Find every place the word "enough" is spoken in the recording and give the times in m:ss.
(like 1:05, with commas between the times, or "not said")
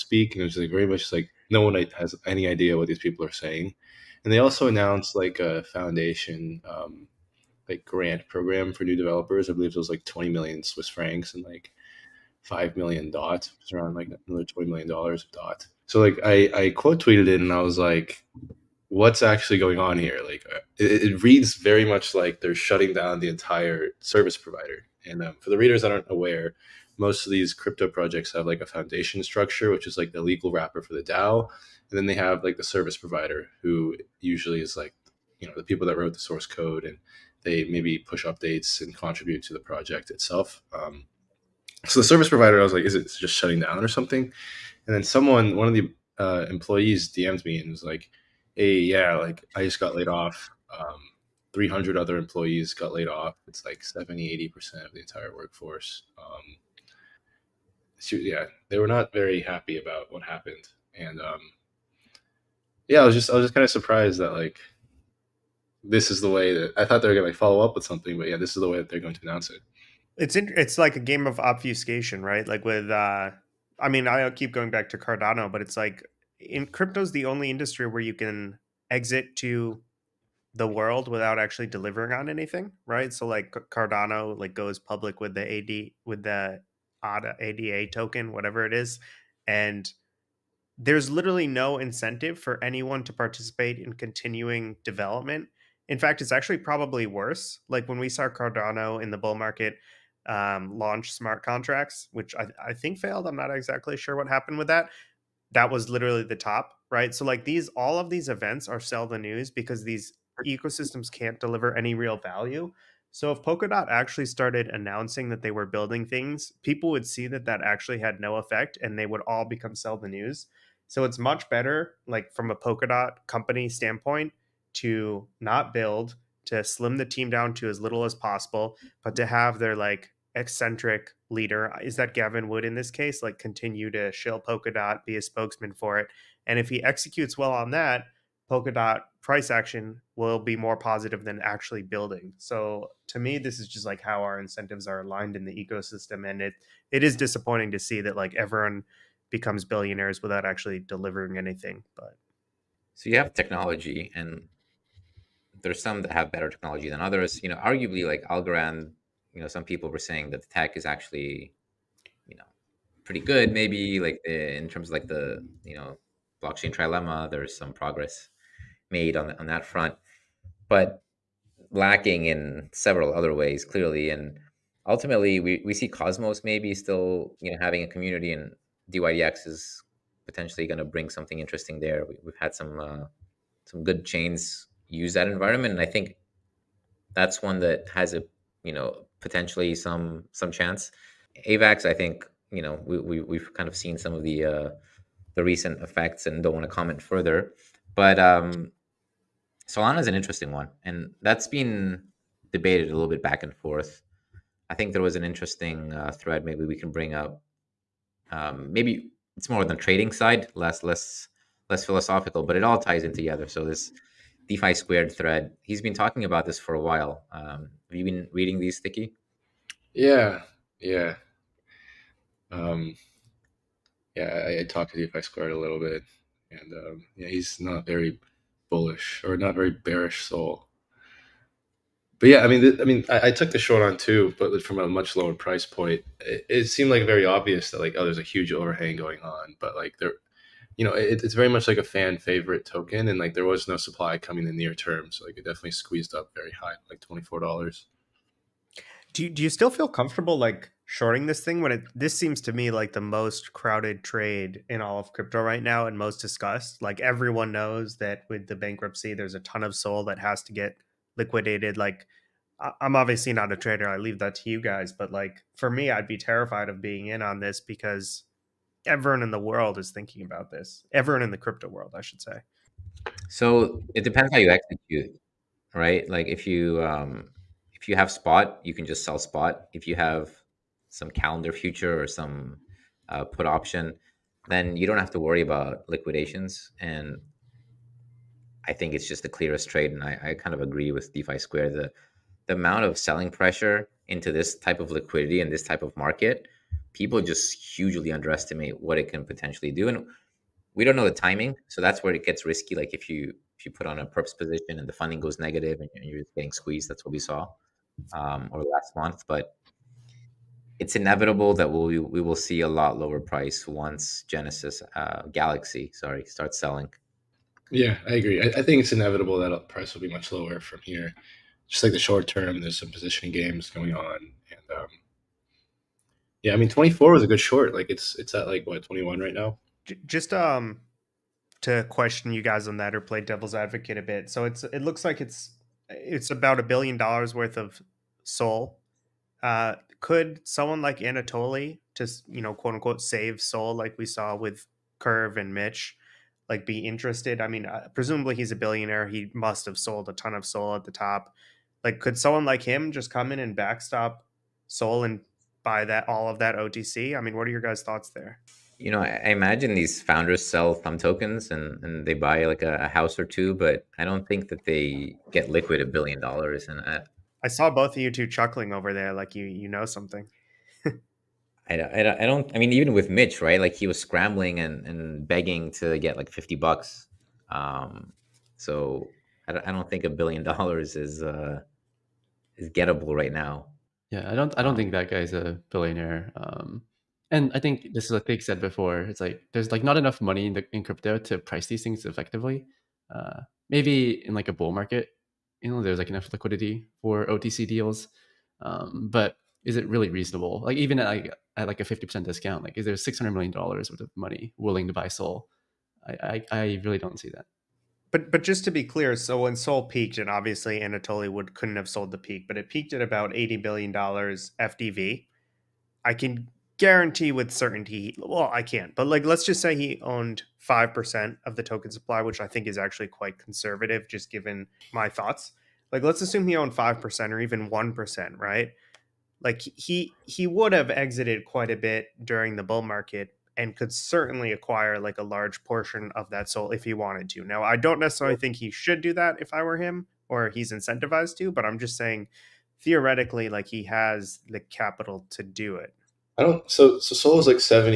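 6:29, 6:36.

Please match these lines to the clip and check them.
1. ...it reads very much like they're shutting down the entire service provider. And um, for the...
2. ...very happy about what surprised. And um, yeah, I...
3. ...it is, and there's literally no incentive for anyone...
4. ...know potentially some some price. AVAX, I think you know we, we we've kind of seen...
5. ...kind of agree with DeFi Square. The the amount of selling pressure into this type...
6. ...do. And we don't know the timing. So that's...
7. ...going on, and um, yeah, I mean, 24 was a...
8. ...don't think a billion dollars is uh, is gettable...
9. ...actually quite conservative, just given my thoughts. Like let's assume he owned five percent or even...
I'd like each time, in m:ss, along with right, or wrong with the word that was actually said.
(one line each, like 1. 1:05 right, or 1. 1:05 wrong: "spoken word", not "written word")
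1. 0:21 right
2. 0:59 wrong: "happened", not "surprised"
3. 1:28 right
4. 3:08 wrong: "chance", not "price"
5. 4:50 right
6. 4:59 right
7. 5:23 right
8. 6:19 right
9. 7:02 right.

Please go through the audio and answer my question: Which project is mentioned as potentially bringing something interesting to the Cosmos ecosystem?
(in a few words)
dYdX.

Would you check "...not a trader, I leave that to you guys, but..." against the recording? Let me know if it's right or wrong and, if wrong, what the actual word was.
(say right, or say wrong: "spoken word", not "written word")
right.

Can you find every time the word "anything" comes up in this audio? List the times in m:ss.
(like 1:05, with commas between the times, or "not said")
1:22, 2:31.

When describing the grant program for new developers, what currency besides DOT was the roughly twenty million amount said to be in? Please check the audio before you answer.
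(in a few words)
Swiss francs.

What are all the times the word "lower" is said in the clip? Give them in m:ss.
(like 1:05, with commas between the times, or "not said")
3:55, 5:12, 5:20.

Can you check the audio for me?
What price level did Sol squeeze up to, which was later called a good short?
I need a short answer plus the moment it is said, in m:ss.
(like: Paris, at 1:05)
$24, at 4:06.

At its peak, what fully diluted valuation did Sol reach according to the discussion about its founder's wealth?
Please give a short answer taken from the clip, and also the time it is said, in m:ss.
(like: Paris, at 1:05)
$80 billion, at 6:53.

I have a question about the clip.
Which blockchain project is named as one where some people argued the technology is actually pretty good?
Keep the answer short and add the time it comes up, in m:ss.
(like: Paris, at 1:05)
Algorand, at 2:38.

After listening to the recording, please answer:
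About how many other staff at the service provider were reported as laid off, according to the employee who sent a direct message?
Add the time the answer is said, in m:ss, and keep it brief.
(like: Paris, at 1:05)
300, at 0:51.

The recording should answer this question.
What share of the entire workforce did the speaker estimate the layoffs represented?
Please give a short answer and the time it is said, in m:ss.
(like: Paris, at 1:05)
70-80%, at 0:53.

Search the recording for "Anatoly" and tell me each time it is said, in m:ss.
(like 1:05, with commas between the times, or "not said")
5:40, 6:50.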